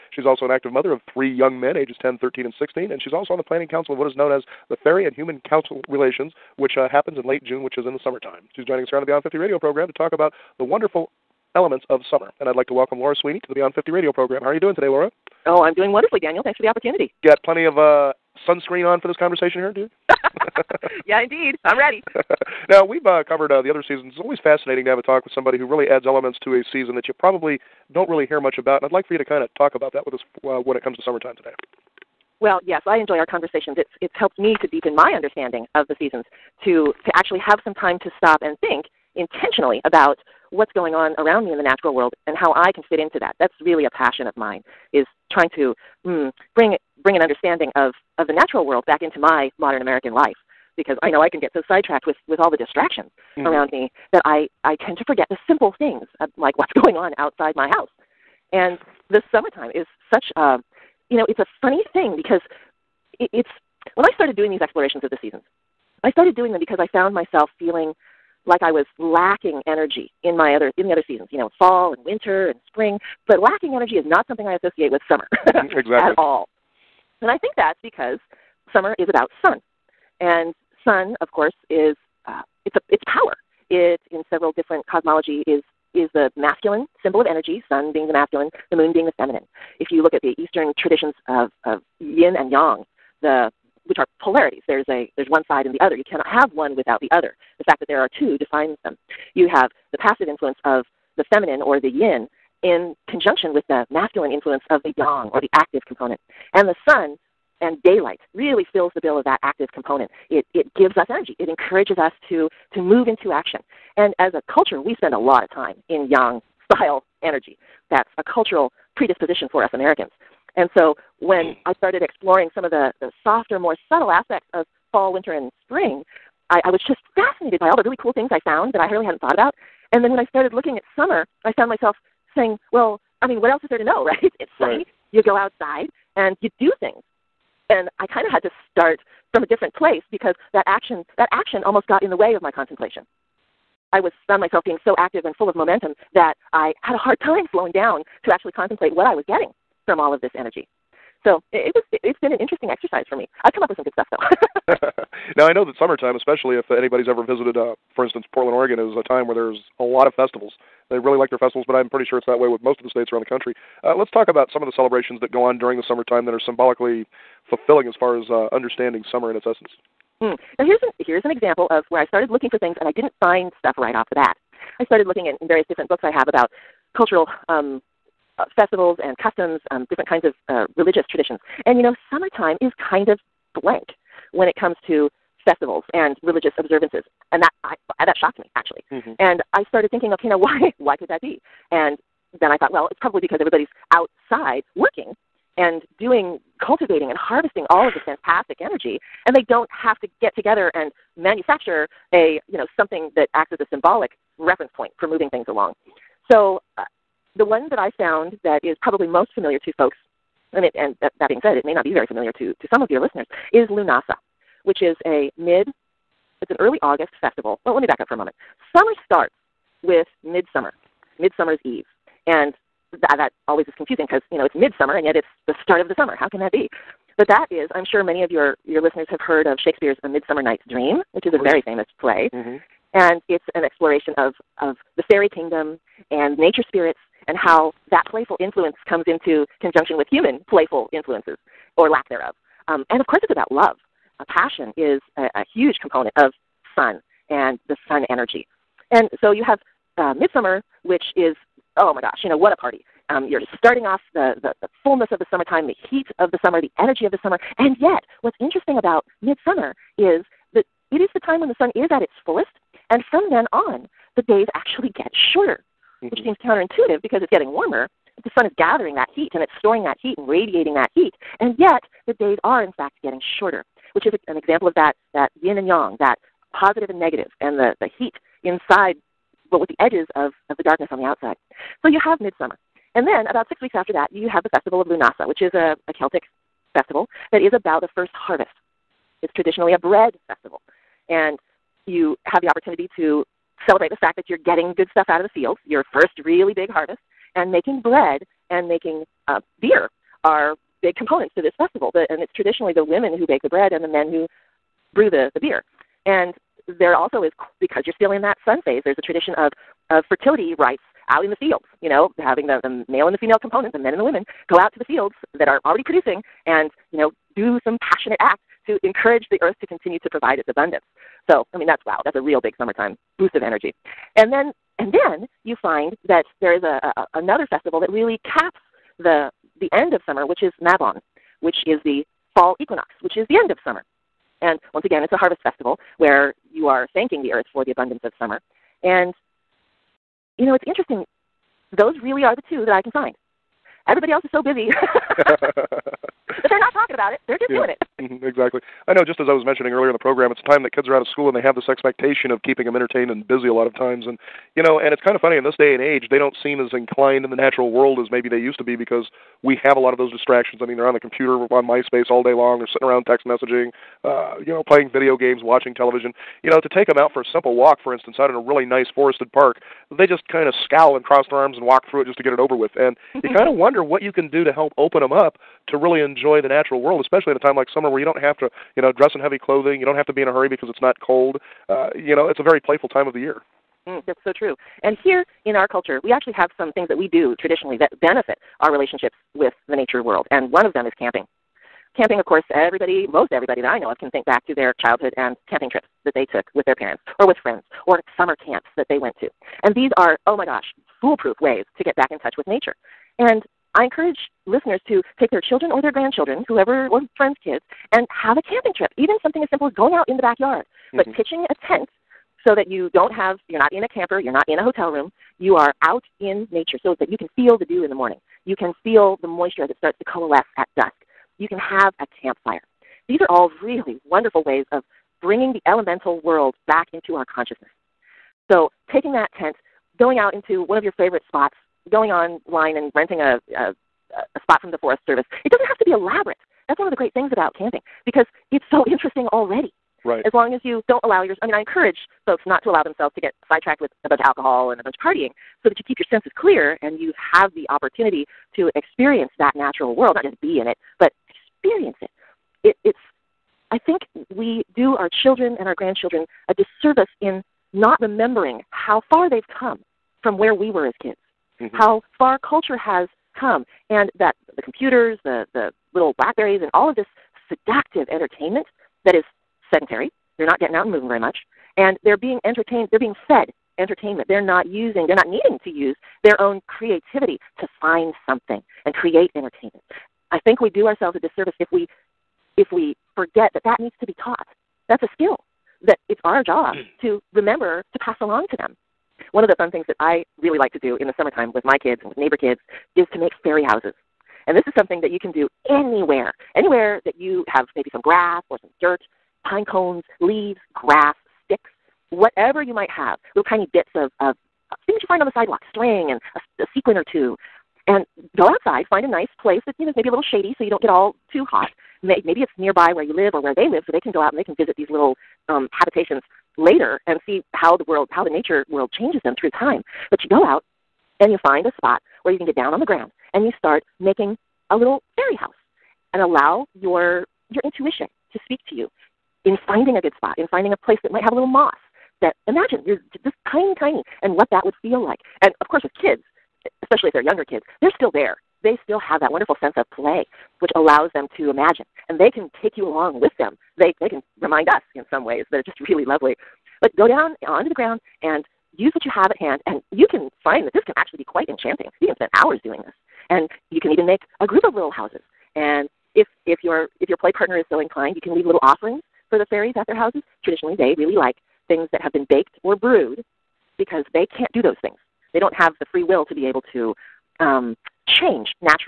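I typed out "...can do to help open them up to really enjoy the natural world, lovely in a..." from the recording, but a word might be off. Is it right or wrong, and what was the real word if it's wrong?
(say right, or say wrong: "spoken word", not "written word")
wrong: "especially", not "lovely".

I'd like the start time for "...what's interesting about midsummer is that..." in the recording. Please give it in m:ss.
4:18.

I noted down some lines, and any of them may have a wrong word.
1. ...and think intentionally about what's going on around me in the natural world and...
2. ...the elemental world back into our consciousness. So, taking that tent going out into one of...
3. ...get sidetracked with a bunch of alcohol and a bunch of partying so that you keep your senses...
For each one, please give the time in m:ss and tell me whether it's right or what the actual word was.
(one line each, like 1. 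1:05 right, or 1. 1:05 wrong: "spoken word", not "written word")
1. 0:38 right
2. 7:05 right
3. 7:23 right.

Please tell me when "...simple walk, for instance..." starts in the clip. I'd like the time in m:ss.
6:07.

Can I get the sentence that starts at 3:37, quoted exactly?
Well, let me back up for a moment.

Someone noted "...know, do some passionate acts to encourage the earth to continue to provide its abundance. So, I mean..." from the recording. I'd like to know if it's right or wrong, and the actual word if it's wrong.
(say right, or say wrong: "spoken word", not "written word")
right.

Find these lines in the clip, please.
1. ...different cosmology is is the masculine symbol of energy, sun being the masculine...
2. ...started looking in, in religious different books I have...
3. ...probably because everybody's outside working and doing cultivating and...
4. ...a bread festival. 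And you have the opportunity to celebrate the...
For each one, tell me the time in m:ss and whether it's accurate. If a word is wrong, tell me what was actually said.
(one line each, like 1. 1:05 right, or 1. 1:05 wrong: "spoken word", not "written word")
1. 1:24 right
2. 2:54 wrong: "various", not "religious"
3. 3:13 right
4. 4:49 right.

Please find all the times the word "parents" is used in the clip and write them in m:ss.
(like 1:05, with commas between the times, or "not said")
6:36.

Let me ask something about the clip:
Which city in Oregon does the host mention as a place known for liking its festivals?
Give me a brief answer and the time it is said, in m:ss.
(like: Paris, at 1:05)
Portland, at 2:38.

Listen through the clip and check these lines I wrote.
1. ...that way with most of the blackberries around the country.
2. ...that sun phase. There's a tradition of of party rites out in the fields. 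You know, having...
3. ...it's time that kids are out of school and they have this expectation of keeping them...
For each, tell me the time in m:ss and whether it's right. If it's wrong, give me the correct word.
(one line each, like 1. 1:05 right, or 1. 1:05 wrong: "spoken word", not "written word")
1. 2:42 wrong: "states", not "blackberries"
2. 5:08 wrong: "fertility", not "party"
3. 5:50 right.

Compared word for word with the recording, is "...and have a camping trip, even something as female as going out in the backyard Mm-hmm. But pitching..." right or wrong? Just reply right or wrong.
wrong.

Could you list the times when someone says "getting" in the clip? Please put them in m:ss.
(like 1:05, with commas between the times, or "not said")
2:29, 4:27, 4:33, 4:54, 7:50.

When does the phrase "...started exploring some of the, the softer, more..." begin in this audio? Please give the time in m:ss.
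2:01.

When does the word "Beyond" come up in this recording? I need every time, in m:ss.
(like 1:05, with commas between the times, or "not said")
0:09, 0:13.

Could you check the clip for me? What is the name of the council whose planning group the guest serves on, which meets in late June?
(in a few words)
Fairy and Human Council Relations.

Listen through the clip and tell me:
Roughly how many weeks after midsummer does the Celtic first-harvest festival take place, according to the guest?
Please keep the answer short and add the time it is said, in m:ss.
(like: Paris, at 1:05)
6 weeks, at 4:43.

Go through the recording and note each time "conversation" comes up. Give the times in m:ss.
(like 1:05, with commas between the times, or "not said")
0:19, 0:33.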